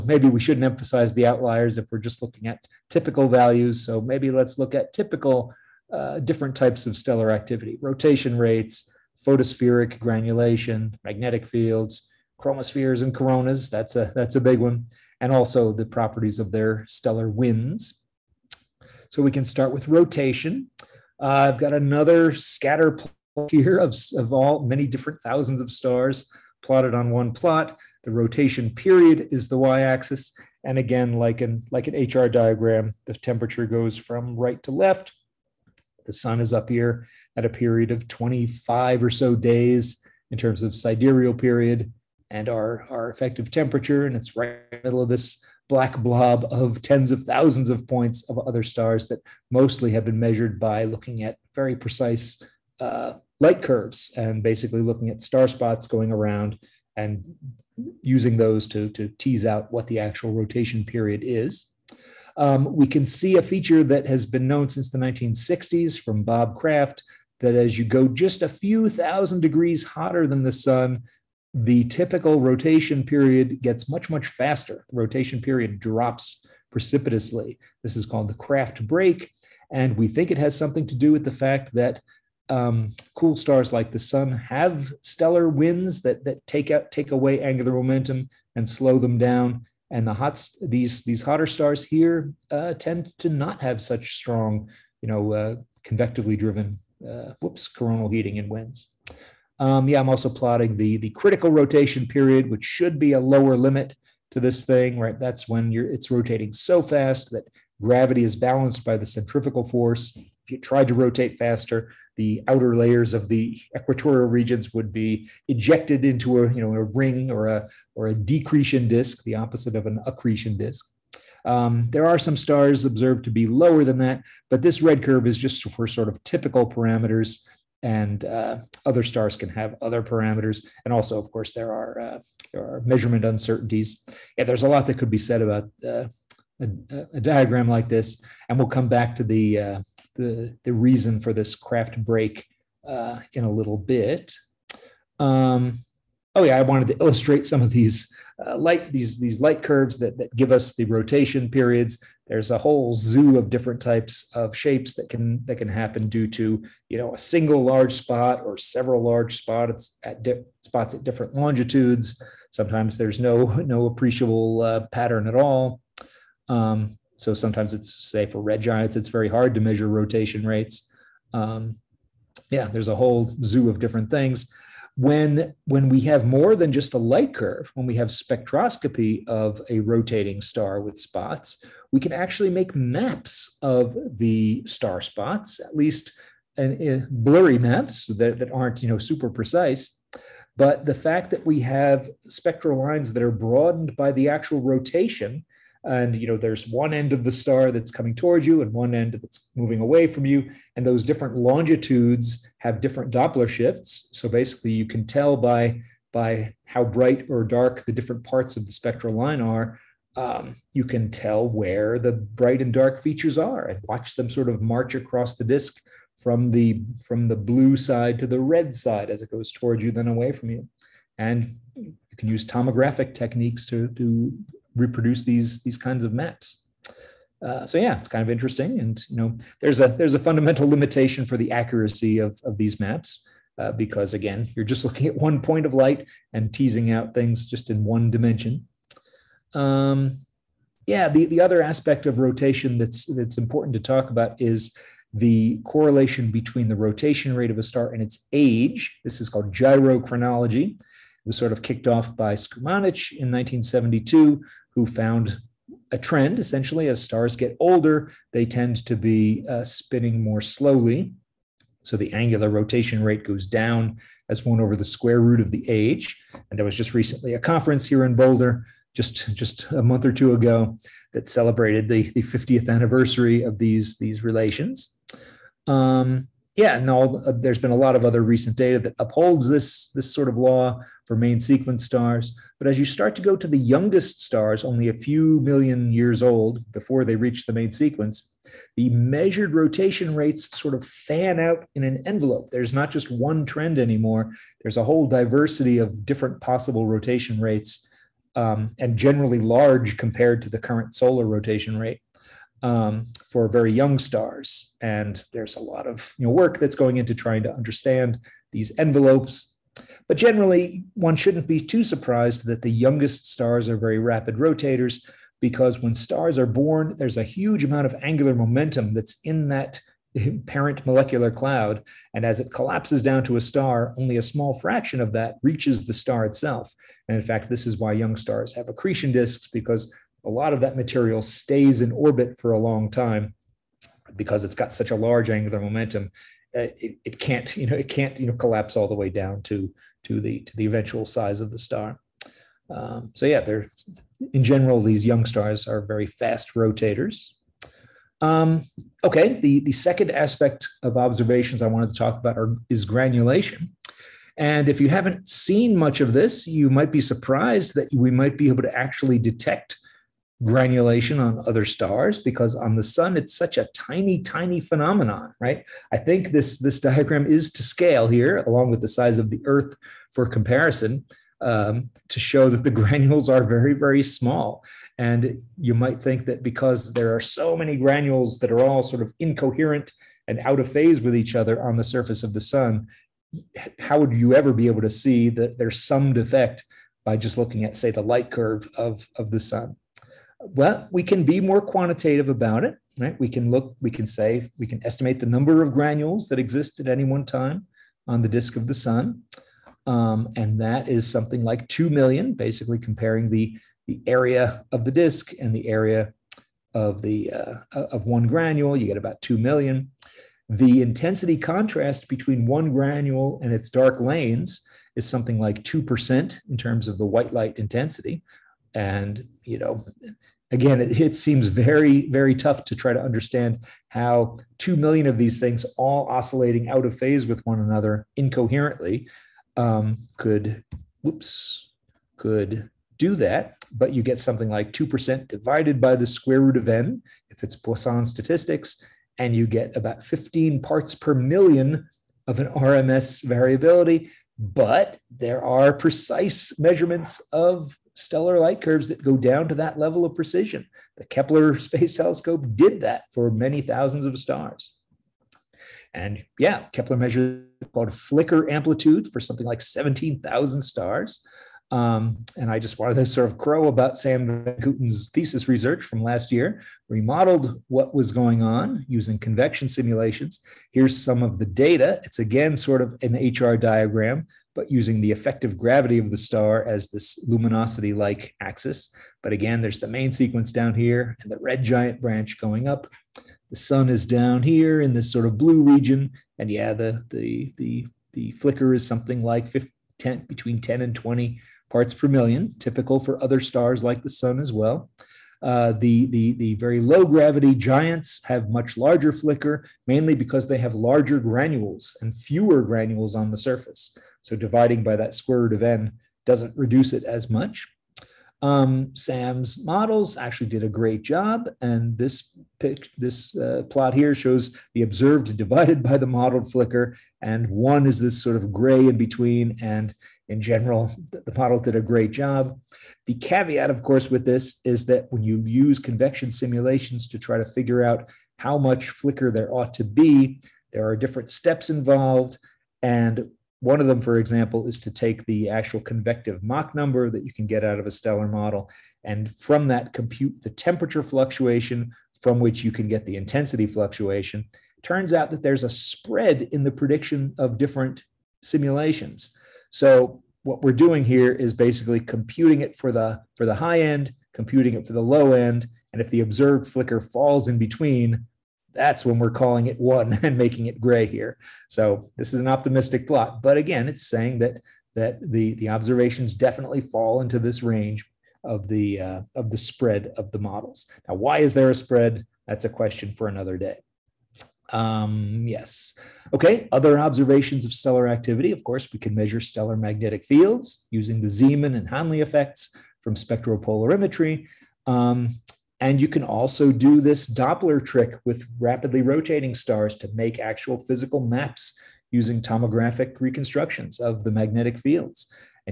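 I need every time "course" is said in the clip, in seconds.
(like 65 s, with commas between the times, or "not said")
131 s, 523 s, 578 s.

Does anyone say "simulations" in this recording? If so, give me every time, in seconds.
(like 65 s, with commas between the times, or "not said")
469 s, 526 s, 548 s.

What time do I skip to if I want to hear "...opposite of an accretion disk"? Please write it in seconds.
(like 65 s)
119 s.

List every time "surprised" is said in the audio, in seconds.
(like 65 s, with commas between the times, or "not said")
311 s, 357 s.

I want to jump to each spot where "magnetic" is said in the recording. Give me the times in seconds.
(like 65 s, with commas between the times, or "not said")
11 s, 579 s, 594 s.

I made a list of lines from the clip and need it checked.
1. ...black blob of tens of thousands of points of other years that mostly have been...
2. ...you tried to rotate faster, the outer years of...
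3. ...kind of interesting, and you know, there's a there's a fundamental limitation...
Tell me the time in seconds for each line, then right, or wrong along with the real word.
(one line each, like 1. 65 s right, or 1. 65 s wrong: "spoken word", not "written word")
1. 45 s wrong: "stars", not "years"
2. 110 s wrong: "layers", not "years"
3. 228 s right.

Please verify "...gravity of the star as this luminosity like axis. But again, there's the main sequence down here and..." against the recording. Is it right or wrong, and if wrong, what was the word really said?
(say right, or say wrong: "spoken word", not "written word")
right.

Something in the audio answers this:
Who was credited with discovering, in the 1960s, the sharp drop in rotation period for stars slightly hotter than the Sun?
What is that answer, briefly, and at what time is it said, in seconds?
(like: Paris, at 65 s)
Bob Kraft, at 66 s.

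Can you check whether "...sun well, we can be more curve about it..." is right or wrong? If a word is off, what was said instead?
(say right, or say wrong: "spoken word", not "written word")
wrong: "quantitative", not "curve".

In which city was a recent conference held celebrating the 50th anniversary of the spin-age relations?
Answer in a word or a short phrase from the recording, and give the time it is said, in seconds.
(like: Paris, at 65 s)
Boulder, at 268 s.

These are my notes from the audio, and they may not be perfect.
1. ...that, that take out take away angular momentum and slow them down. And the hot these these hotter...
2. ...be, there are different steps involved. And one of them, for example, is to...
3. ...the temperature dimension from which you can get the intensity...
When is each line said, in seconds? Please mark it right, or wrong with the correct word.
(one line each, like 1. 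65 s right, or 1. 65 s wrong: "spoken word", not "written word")
1. 86 s right
2. 529 s right
3. 540 s wrong: "fluctuation", not "dimension".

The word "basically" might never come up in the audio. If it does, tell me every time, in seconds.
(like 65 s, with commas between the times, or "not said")
54 s, 204 s, 402 s, 551 s.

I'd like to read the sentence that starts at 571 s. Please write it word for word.
Now, why is there a spread?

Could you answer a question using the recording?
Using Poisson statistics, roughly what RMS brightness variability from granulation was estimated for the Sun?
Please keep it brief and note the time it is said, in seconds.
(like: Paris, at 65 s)
15 parts per million, at 440 s.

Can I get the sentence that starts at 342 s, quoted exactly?
Um, so yeah, they're in general these young stars are very fast rotators.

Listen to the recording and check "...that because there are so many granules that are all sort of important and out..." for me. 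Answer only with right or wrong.
wrong.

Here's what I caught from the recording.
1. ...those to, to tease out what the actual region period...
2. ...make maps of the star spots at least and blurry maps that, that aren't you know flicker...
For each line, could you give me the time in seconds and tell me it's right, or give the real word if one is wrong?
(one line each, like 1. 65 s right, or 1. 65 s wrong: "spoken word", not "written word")
1. 58 s wrong: "rotation", not "region"
2. 182 s wrong: "super", not "flicker".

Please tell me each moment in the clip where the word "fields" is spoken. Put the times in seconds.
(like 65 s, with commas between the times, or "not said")
11 s, 580 s, 594 s.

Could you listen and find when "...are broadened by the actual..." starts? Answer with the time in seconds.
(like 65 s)
193 s.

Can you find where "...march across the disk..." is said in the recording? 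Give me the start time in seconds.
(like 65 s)
214 s.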